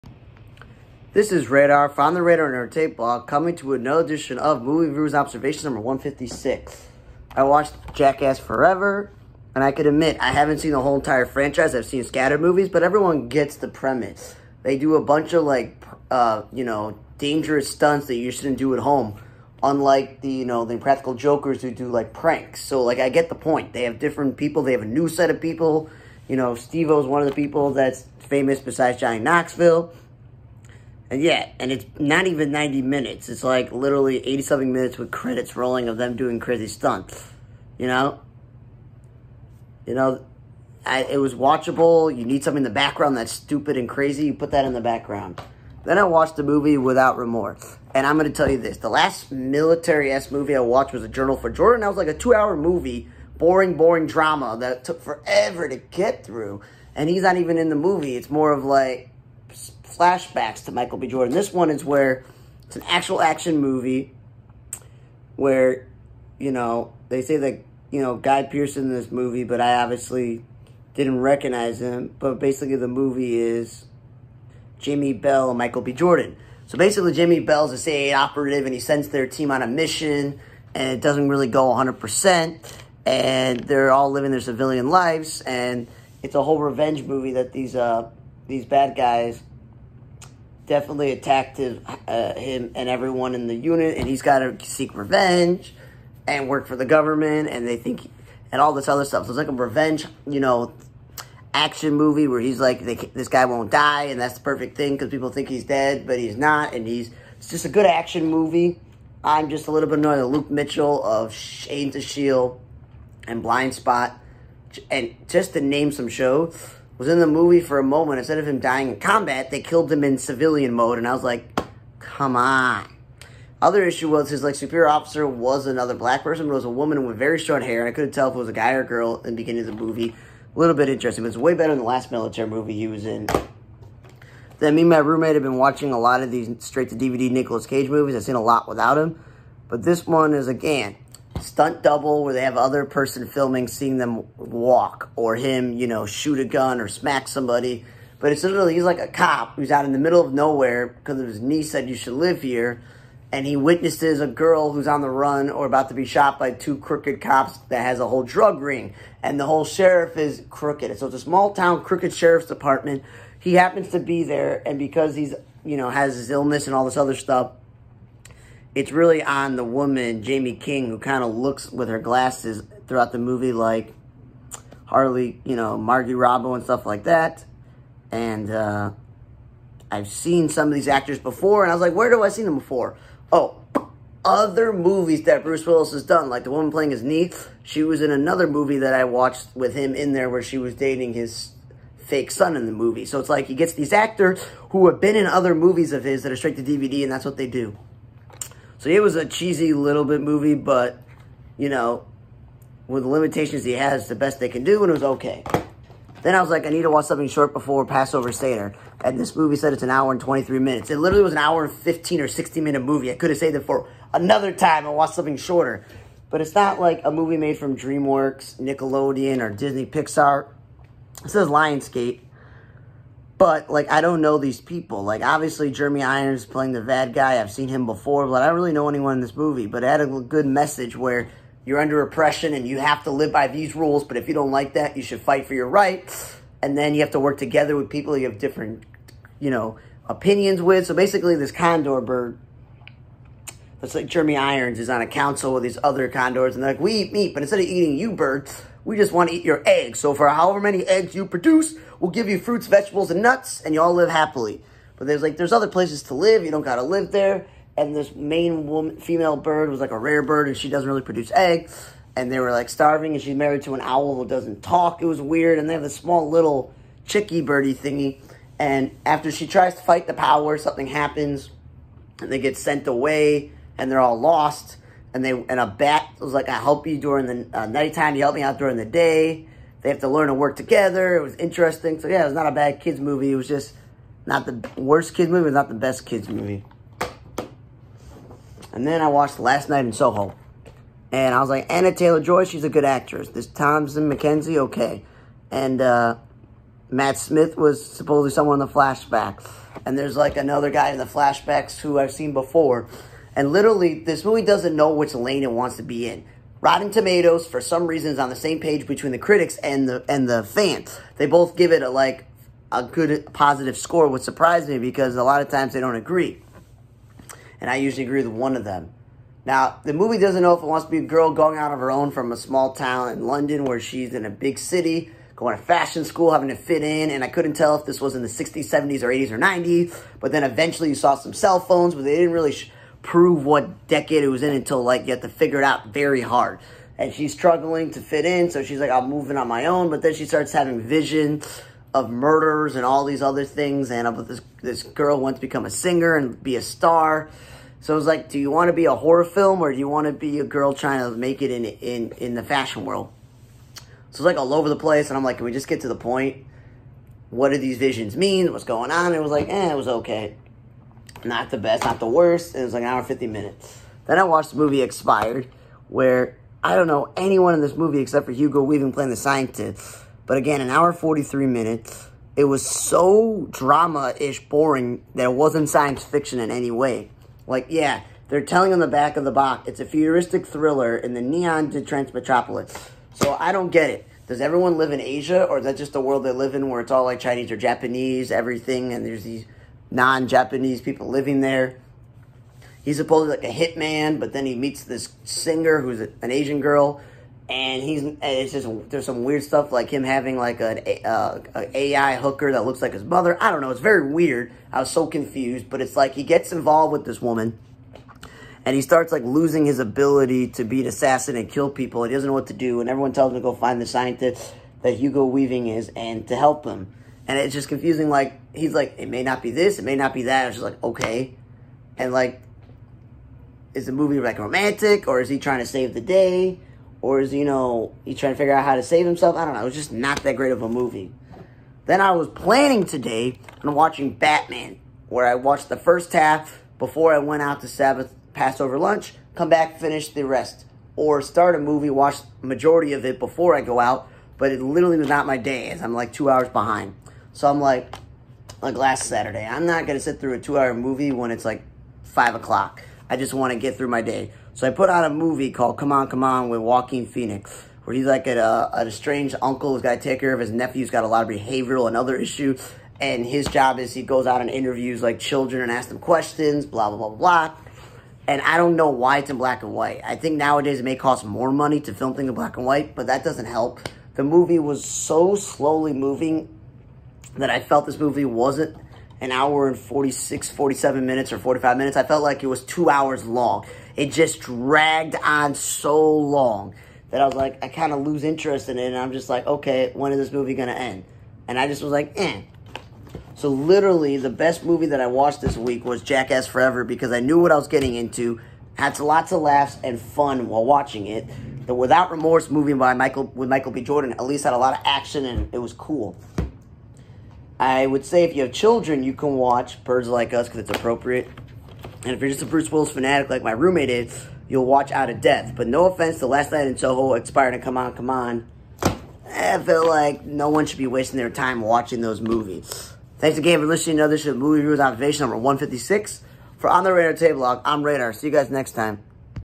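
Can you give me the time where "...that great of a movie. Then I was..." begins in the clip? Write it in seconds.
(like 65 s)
430 s.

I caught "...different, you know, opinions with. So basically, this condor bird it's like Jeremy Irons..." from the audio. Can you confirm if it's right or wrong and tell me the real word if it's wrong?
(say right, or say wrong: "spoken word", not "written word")
right.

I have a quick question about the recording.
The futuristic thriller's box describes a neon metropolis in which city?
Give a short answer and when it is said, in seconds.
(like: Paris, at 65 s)
Detroit, at 381 s.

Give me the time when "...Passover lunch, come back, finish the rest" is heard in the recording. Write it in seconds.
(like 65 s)
438 s.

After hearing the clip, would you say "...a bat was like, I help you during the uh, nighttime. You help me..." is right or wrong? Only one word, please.
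right.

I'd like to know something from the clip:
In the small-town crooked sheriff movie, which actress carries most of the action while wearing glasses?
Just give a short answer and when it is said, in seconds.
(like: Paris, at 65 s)
Jaime King, at 170 s.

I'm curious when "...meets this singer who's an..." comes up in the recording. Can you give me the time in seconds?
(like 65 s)
394 s.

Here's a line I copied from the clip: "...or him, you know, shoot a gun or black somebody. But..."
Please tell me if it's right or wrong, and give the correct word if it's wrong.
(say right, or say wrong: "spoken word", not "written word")
wrong: "smack", not "black".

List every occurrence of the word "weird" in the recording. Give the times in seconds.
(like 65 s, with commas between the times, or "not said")
265 s, 399 s, 404 s.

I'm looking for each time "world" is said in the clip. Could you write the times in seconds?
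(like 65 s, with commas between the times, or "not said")
352 s, 385 s.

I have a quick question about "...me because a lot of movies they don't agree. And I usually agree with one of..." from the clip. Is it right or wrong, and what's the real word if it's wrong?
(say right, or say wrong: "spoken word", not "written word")
wrong: "times", not "movies".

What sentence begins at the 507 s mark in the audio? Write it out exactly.
I would say if you have children, you can watch Birds Like Us because it's appropriate.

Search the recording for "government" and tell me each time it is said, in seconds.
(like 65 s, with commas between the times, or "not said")
96 s.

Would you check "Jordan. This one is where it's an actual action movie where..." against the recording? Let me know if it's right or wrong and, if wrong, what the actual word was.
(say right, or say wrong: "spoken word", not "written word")
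right.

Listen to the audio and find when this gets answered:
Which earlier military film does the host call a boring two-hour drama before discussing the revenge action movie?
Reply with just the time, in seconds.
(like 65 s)
51 s.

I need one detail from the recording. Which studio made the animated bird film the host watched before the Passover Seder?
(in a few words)
Lionsgate.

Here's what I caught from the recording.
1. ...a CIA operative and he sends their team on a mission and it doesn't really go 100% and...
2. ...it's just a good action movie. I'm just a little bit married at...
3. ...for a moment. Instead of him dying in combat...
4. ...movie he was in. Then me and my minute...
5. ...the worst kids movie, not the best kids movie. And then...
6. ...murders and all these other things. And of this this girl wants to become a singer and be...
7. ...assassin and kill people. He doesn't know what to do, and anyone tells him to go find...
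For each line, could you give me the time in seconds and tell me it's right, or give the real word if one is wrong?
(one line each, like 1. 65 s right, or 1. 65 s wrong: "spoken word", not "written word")
1. 77 s right
2. 107 s wrong: "annoyed", not "married"
3. 117 s right
4. 132 s wrong: "roommate", not "minute"
5. 284 s right
6. 342 s right
7. 410 s wrong: "everyone", not "anyone".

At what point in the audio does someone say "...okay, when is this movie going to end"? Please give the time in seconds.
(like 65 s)
489 s.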